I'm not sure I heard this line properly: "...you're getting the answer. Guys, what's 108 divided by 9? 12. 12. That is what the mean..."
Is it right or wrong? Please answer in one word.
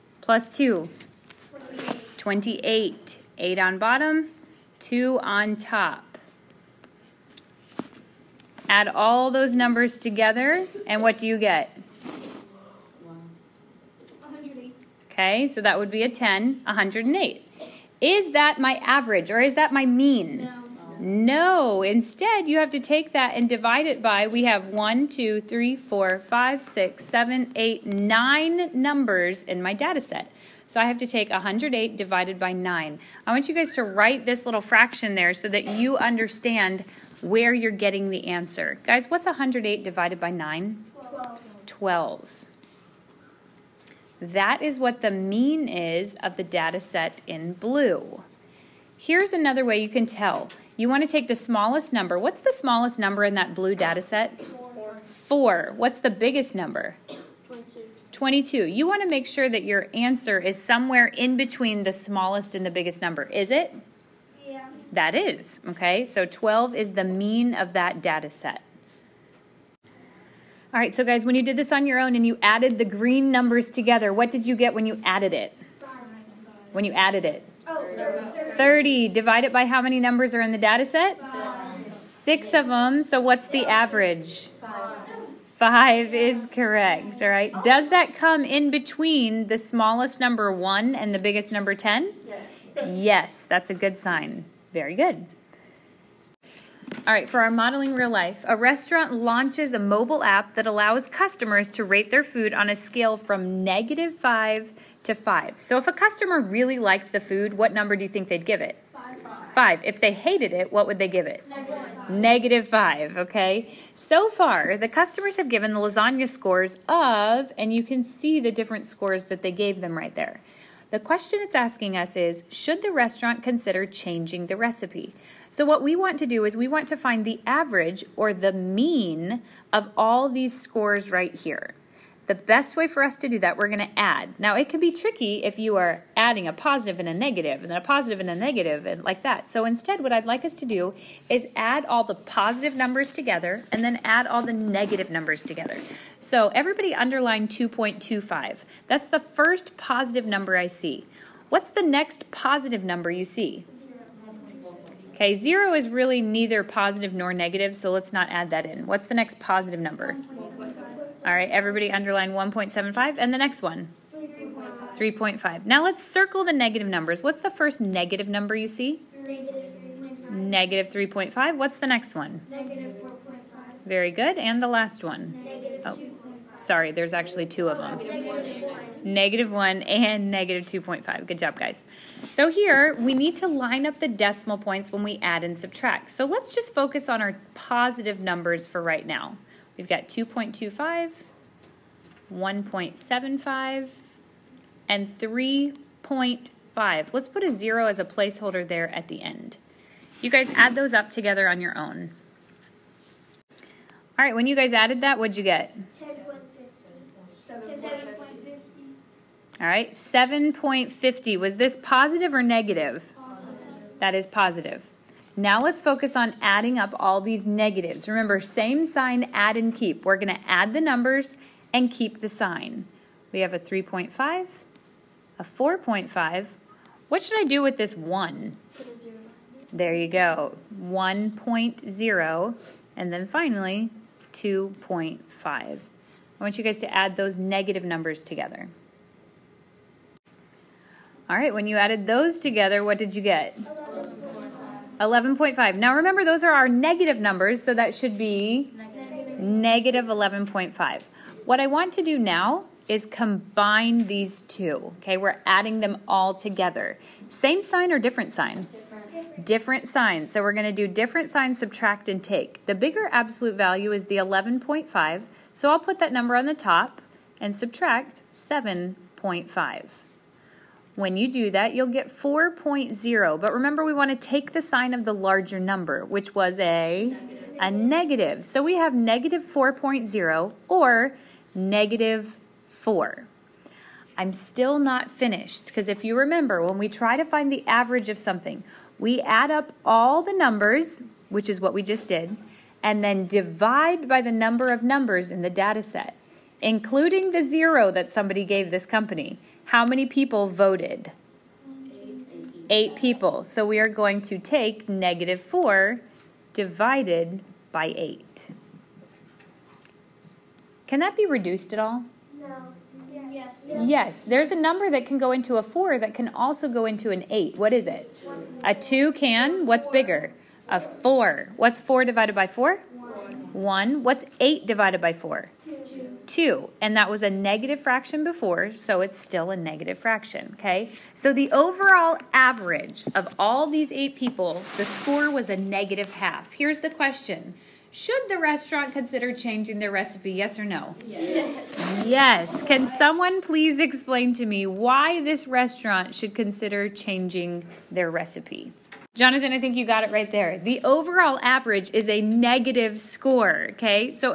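right.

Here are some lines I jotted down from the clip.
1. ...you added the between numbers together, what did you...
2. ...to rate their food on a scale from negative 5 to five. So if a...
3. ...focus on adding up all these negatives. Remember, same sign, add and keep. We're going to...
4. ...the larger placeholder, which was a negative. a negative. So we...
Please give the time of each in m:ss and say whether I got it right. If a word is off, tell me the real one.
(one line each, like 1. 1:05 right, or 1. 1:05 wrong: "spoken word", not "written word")
1. 1:12 wrong: "green", not "between"
2. 1:41 right
3. 3:35 right
4. 4:35 wrong: "number", not "placeholder".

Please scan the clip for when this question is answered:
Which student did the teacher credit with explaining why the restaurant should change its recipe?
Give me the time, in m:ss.
5:49.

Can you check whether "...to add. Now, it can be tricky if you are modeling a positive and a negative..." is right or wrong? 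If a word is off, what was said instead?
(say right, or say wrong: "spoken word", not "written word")
wrong: "adding", not "modeling".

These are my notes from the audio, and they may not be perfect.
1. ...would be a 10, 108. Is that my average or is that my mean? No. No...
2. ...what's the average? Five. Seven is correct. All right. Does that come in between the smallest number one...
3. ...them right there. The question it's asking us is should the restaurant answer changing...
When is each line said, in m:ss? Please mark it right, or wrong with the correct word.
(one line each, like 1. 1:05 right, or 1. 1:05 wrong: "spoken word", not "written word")
1. 0:15 right
2. 1:23 wrong: "Five", not "Seven"
3. 1:59 wrong: "consider", not "answer".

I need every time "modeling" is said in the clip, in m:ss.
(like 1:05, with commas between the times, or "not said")
1:37.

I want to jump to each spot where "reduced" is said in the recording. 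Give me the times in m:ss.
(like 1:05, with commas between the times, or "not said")
5:11.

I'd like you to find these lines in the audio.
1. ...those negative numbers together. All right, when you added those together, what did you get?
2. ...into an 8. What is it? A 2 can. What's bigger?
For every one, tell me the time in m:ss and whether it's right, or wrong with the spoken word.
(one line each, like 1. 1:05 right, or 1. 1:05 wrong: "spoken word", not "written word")
1. 3:57 right
2. 5:16 right.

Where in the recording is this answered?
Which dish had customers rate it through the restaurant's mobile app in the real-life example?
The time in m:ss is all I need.
1:55.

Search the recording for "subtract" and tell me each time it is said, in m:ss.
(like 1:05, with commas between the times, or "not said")
3:05, 4:21, 4:27.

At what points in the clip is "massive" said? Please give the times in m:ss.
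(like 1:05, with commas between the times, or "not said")
not said.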